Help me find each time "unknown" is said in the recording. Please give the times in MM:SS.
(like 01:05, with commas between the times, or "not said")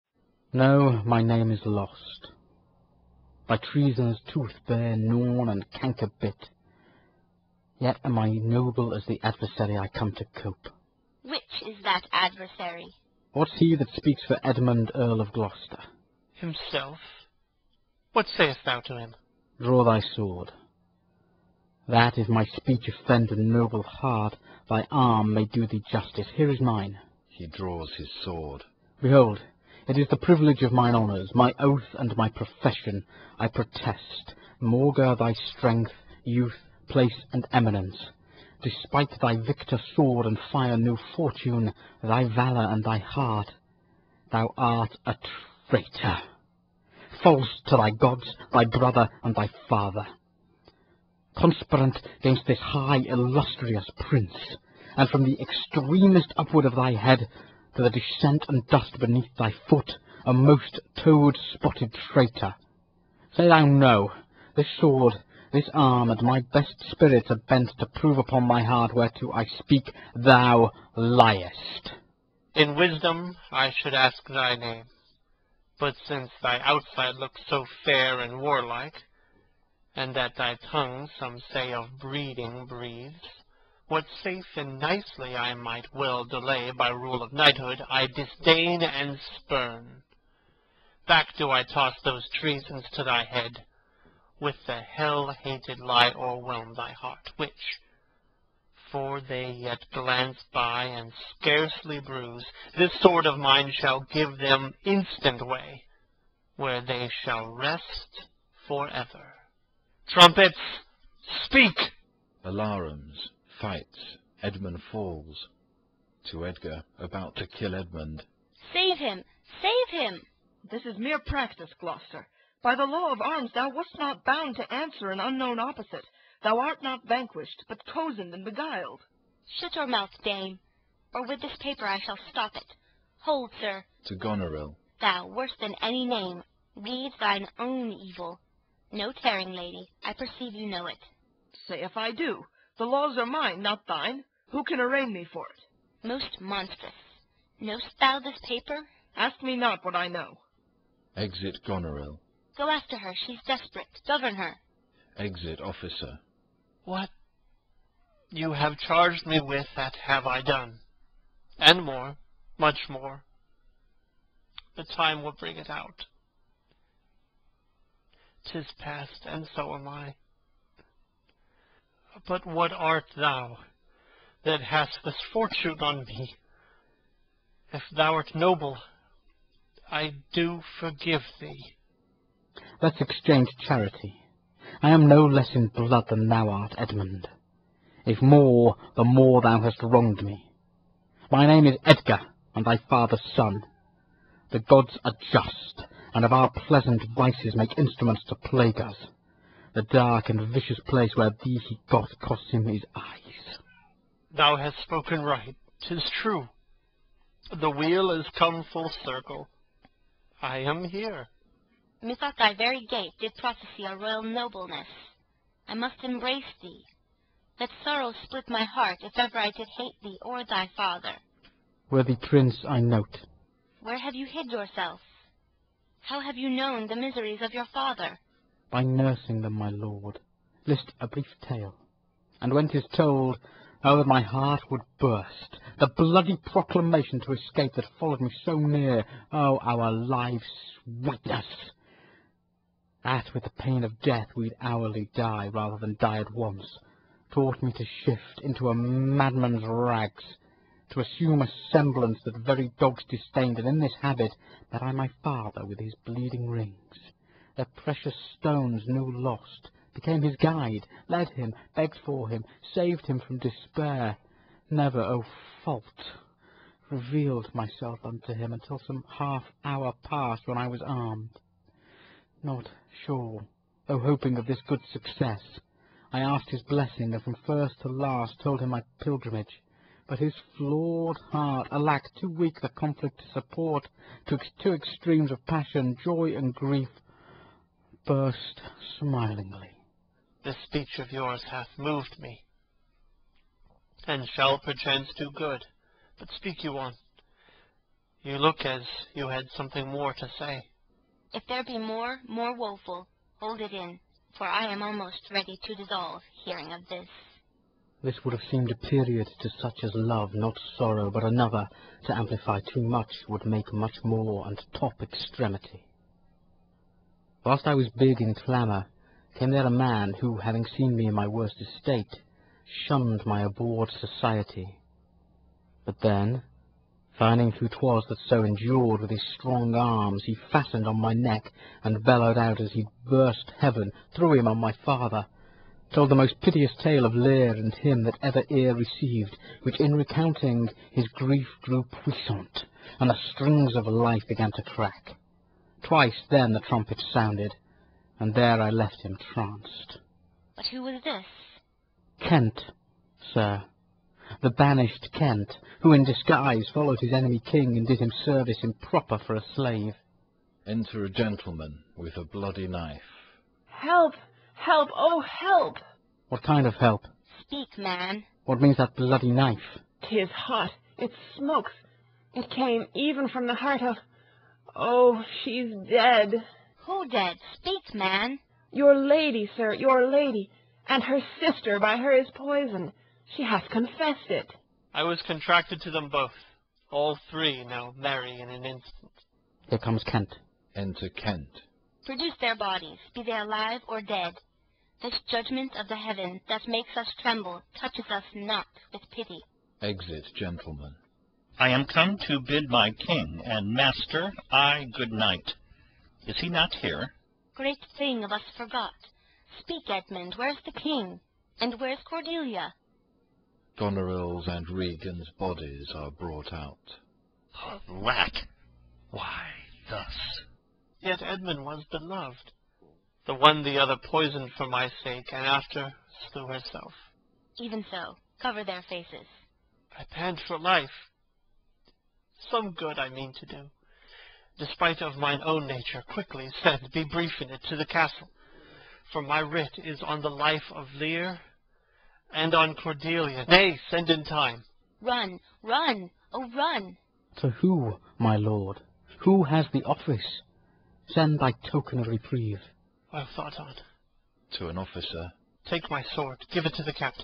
02:05.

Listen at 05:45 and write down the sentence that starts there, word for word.
Twice then the trumpet sounded, and there I left him tranced.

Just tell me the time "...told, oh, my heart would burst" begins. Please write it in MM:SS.
03:52.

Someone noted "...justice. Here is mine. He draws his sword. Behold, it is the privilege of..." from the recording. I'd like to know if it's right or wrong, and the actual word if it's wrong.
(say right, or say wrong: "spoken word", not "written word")
right.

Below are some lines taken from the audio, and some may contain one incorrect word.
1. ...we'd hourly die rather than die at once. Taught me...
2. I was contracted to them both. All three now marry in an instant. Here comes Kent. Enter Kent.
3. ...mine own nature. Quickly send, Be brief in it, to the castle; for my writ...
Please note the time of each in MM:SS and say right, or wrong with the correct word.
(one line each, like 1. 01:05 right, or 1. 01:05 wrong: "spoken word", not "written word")
1. 04:04 right
2. 06:24 right
3. 07:15 right.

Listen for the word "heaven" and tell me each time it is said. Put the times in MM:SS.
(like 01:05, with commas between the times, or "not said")
05:33, 06:35.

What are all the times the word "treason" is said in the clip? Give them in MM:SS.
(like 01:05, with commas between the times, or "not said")
00:03, 01:32.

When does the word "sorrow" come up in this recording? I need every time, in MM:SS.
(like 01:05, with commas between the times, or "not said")
03:37, 05:10.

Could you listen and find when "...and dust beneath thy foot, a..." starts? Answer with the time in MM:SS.
00:58.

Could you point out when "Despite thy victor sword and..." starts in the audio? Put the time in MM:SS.
00:38.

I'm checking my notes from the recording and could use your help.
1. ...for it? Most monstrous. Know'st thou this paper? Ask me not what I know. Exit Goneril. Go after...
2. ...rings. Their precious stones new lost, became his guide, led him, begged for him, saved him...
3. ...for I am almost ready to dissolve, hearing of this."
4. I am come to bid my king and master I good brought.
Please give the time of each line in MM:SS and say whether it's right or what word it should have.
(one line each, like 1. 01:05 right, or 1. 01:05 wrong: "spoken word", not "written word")
1. 02:25 right
2. 04:16 right
3. 05:04 right
4. 06:41 wrong: "night", not "brought".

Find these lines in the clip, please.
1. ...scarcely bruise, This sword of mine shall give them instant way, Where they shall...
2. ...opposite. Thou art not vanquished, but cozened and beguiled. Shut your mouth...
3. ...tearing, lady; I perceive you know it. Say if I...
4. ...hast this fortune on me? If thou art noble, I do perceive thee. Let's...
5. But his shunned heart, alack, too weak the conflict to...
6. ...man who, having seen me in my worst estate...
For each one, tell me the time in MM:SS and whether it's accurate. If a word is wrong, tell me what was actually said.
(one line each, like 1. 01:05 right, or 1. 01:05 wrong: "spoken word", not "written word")
1. 01:41 right
2. 02:05 right
3. 02:19 right
4. 02:54 wrong: "forgive", not "perceive"
5. 04:40 wrong: "flawed", not "shunned"
6. 05:19 right.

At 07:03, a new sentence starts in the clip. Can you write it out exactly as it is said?
The one the other poisoned for my sake, and after slew herself.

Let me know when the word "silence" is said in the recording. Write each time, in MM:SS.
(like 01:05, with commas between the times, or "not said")
not said.